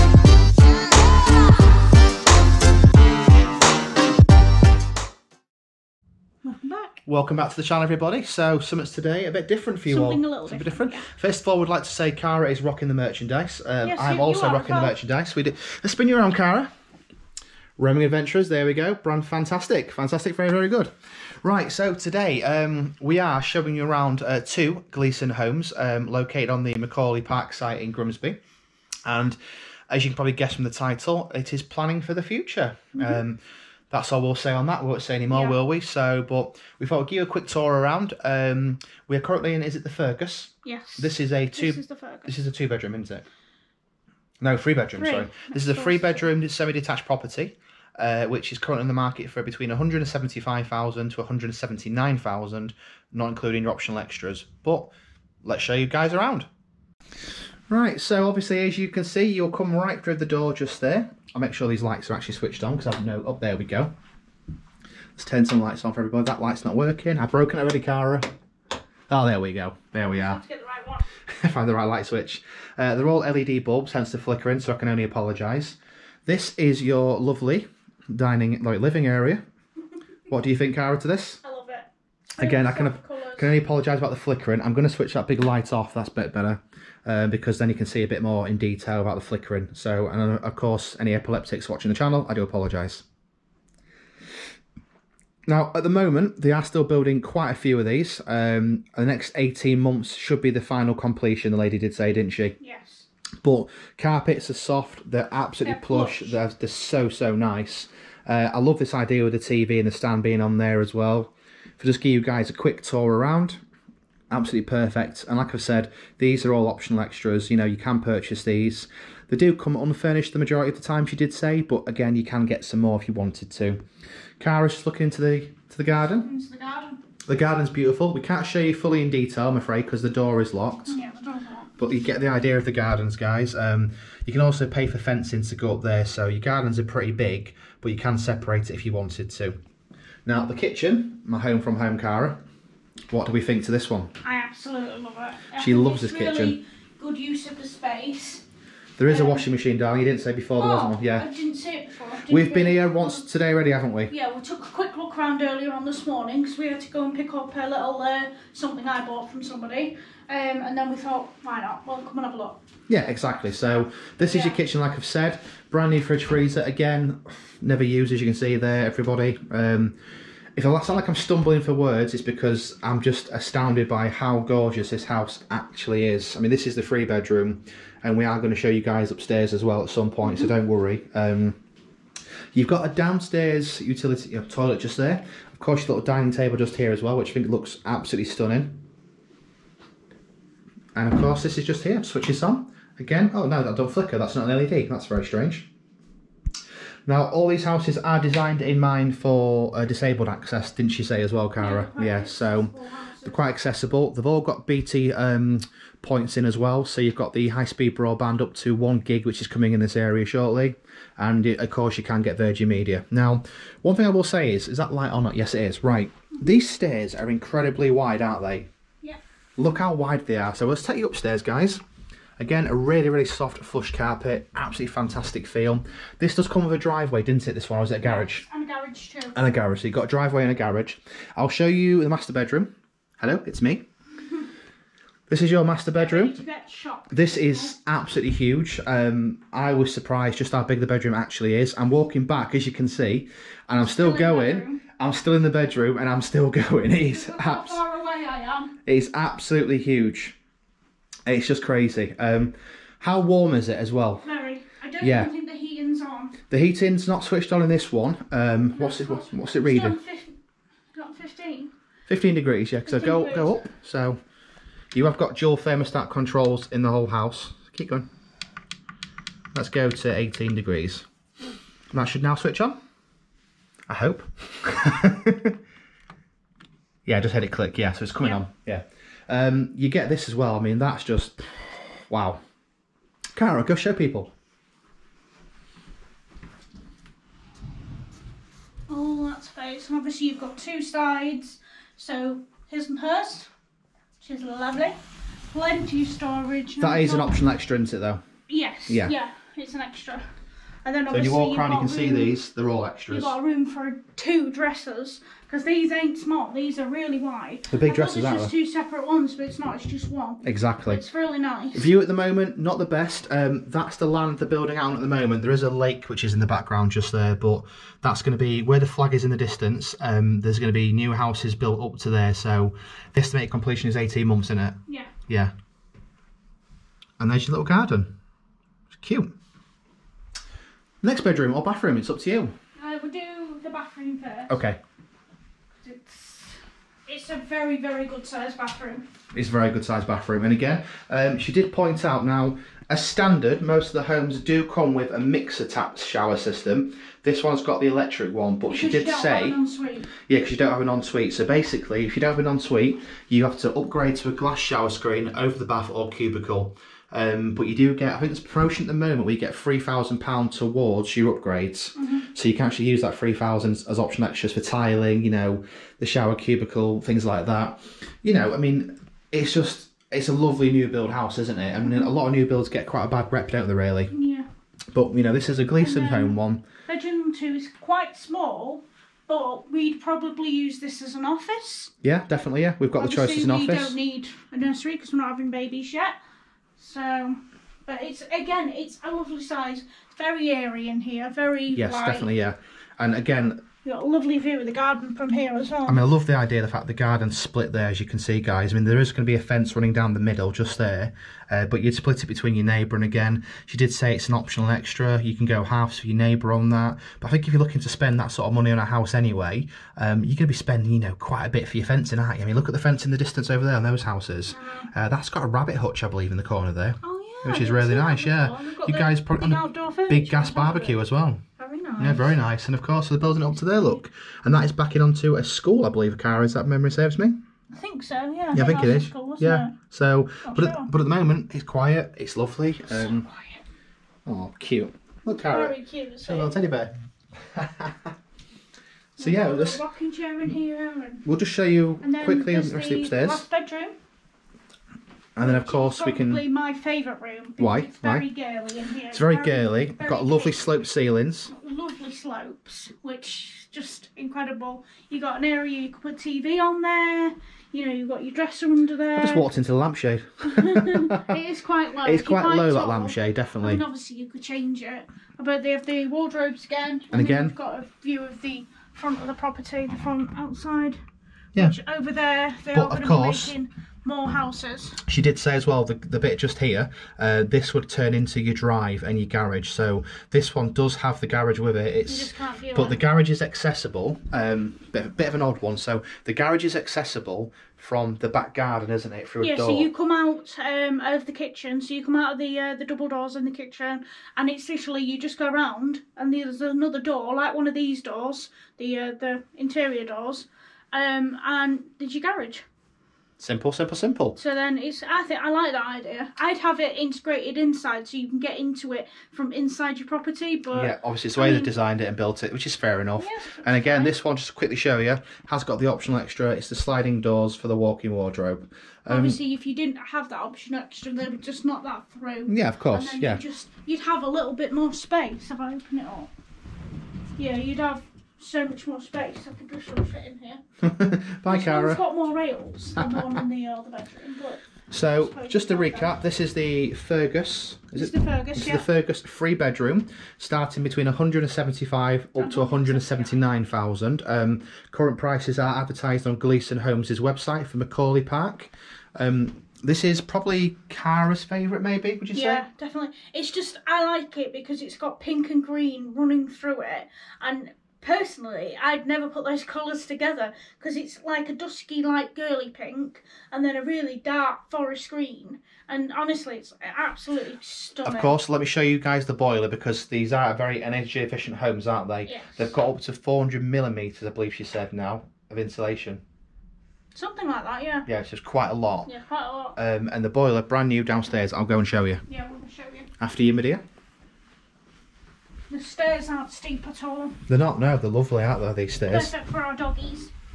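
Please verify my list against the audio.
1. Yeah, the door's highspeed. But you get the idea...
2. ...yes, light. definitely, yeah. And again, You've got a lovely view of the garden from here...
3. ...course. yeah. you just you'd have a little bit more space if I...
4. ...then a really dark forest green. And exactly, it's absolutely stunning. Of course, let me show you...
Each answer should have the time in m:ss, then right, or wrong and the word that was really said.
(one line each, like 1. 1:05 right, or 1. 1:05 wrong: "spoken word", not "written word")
1. 2:10 wrong: "locked", not "highspeed"
2. 6:31 right
3. 8:42 right
4. 9:23 wrong: "honestly", not "exactly".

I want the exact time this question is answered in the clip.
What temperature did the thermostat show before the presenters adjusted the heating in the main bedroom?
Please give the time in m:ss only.
4:22.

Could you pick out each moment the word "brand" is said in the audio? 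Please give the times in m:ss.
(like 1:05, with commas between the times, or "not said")
0:18, 2:45, 9:40.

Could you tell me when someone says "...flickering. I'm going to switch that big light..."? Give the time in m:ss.
1:24.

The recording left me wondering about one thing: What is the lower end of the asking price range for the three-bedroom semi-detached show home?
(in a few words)
175,000.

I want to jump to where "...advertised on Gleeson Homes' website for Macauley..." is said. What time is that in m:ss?
9:05.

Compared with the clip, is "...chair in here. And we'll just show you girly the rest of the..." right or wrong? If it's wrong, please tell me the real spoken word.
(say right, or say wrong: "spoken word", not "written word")
wrong: "quickly", not "girly".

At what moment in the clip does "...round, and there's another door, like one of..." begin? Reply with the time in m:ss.
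8:15.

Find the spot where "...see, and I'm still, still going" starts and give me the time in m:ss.
4:02.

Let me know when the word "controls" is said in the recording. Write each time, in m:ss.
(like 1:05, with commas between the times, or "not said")
4:26.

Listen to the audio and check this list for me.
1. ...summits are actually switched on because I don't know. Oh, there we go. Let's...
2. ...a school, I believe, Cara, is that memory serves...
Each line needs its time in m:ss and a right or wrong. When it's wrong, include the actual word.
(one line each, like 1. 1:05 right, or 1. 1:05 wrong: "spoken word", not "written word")
1. 1:01 wrong: "lights", not "summits"
2. 7:05 right.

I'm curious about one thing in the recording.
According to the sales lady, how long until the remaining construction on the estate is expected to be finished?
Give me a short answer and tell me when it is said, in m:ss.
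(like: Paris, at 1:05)
18 months, at 1:38.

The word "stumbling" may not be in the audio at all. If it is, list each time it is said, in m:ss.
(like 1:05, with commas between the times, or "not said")
2:51.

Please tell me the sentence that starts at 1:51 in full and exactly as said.
If I just give you guys a quick tour around absolutely perfect.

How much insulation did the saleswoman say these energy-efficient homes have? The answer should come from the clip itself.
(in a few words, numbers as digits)
400 millimetres.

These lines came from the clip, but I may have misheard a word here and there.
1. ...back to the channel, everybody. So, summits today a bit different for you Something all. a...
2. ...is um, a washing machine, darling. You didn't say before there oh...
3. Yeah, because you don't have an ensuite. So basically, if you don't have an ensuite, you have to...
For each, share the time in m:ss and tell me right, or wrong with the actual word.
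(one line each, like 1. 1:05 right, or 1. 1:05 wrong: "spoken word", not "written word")
1. 0:07 right
2. 2:29 right
3. 5:50 right.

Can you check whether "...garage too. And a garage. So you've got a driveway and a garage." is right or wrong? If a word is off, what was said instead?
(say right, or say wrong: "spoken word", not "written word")
right.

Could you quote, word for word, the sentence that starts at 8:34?
this one just to quickly show you has got the optional extra, it's the sliding doors for the walk-in wardrobe.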